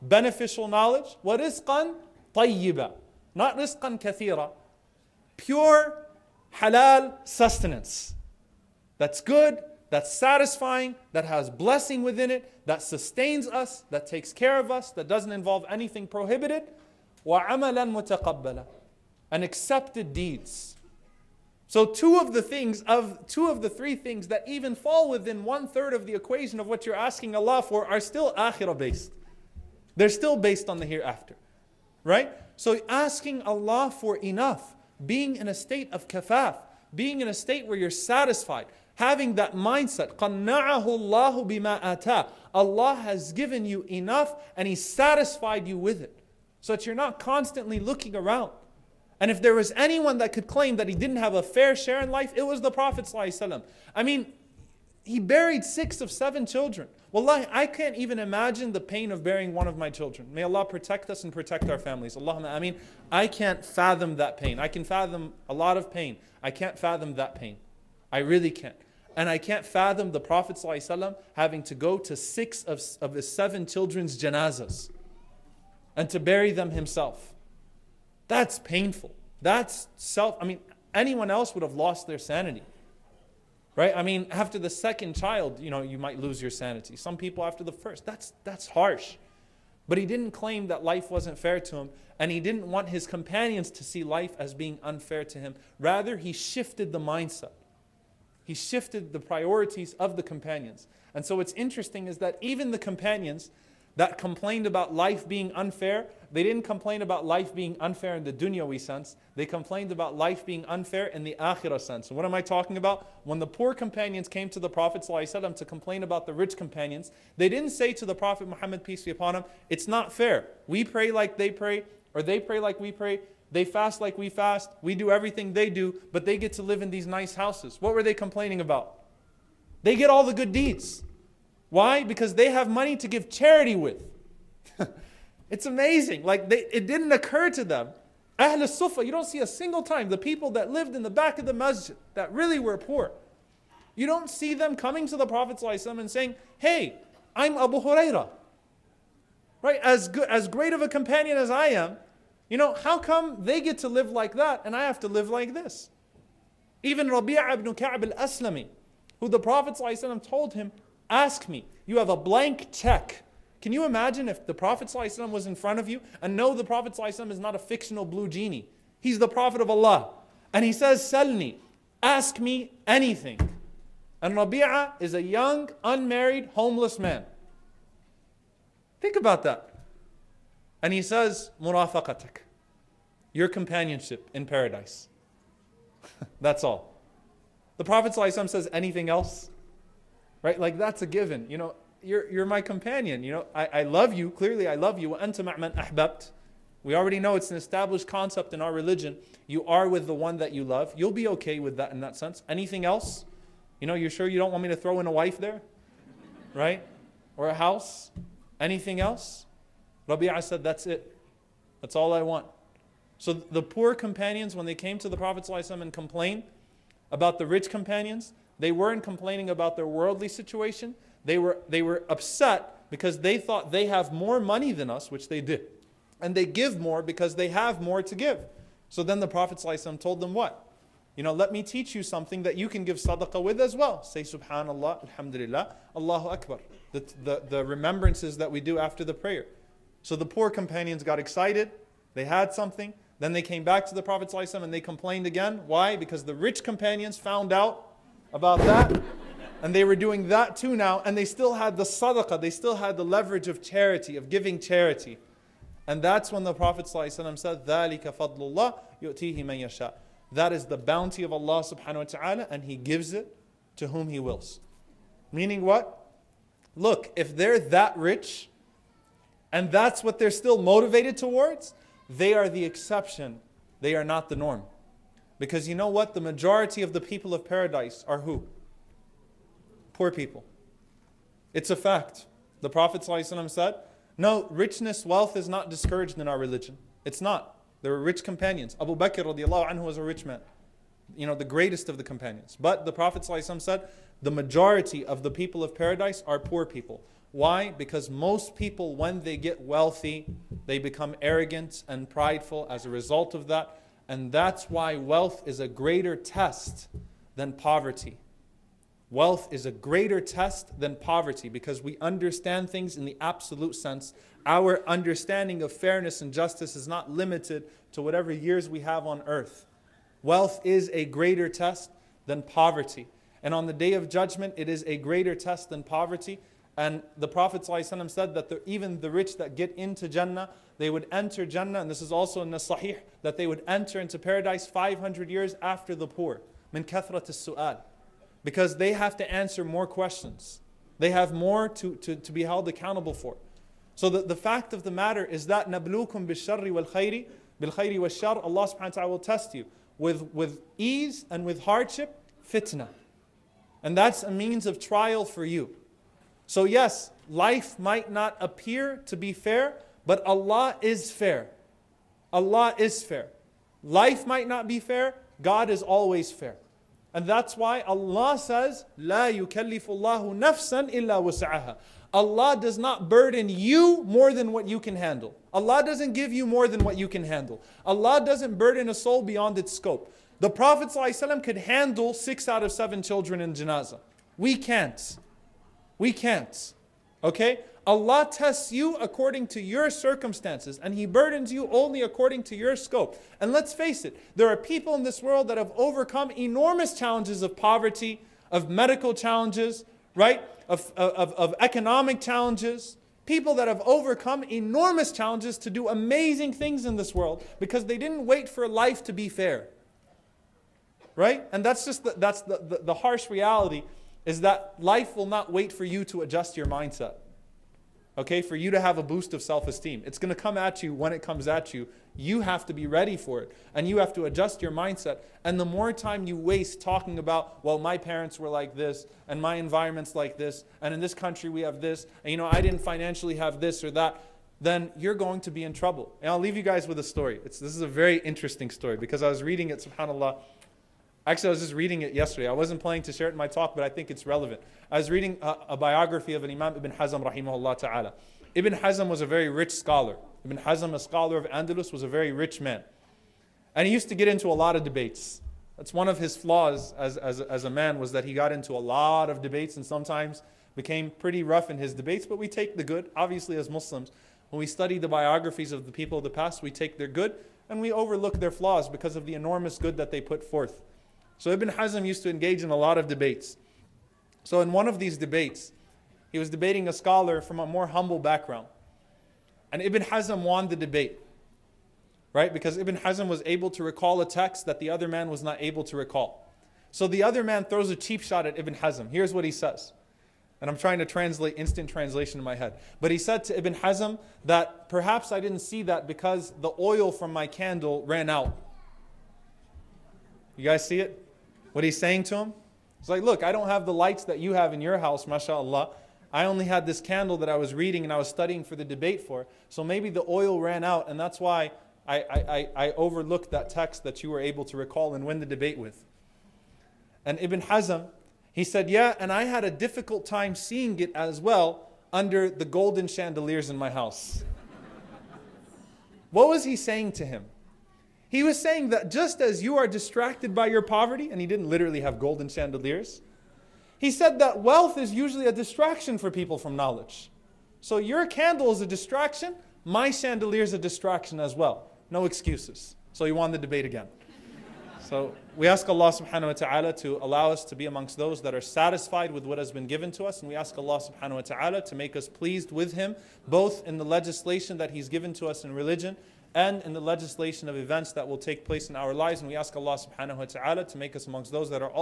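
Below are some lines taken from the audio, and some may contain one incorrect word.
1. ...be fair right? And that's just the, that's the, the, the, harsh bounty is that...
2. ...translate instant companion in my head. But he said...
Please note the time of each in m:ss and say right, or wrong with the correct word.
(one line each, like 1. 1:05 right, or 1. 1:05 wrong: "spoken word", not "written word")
1. 6:49 wrong: "reality", not "bounty"
2. 8:11 wrong: "translation", not "companion".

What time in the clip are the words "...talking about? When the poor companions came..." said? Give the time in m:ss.
1:52.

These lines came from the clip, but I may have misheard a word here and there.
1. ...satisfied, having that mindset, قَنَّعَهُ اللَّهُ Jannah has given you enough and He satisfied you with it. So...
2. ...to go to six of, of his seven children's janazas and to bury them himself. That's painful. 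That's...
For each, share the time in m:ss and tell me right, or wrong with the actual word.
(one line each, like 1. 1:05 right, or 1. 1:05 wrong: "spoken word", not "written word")
1. 0:37 wrong: "Allah", not "Jannah"
2. 1:11 right.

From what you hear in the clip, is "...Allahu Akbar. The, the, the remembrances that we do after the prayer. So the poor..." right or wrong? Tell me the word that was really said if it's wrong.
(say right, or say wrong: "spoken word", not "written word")
right.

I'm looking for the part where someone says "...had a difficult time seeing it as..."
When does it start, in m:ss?
8:39.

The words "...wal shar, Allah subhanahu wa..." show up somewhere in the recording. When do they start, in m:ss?
5:47.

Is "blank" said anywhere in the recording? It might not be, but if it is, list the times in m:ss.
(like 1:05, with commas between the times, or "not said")
2:42.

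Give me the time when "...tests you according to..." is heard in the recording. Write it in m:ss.
6:28.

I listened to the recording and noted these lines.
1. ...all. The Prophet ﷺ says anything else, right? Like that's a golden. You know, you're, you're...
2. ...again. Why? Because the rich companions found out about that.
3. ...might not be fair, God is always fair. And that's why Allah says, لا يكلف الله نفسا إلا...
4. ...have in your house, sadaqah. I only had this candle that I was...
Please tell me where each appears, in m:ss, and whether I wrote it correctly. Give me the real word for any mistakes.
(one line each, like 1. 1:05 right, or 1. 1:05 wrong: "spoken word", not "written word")
1. 3:06 wrong: "given", not "golden"
2. 4:05 right
3. 6:04 right
4. 8:24 wrong: "mashallah", not "sadaqah".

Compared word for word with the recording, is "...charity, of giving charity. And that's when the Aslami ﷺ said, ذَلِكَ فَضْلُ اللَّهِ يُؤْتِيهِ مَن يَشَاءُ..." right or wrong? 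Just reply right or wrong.
wrong.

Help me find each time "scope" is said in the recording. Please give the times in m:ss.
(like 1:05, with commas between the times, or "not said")
6:19, 6:32.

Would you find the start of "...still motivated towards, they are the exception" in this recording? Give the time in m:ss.
4:30.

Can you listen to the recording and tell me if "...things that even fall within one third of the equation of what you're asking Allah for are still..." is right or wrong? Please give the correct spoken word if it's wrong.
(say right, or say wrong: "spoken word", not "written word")
right.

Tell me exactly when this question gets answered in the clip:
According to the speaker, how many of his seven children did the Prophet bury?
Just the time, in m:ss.
0:55.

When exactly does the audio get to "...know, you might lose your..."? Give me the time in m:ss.
1:25.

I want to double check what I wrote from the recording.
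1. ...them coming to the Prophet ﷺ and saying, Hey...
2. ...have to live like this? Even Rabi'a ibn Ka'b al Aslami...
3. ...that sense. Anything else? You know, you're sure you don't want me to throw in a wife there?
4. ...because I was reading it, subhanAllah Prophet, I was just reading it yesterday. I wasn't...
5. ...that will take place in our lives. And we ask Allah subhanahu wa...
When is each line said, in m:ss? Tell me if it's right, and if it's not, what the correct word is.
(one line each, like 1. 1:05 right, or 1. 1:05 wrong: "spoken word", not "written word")
1. 2:24 right
2. 2:34 right
3. 3:21 right
4. 7:18 wrong: "Actually", not "Prophet"
5. 9:18 right.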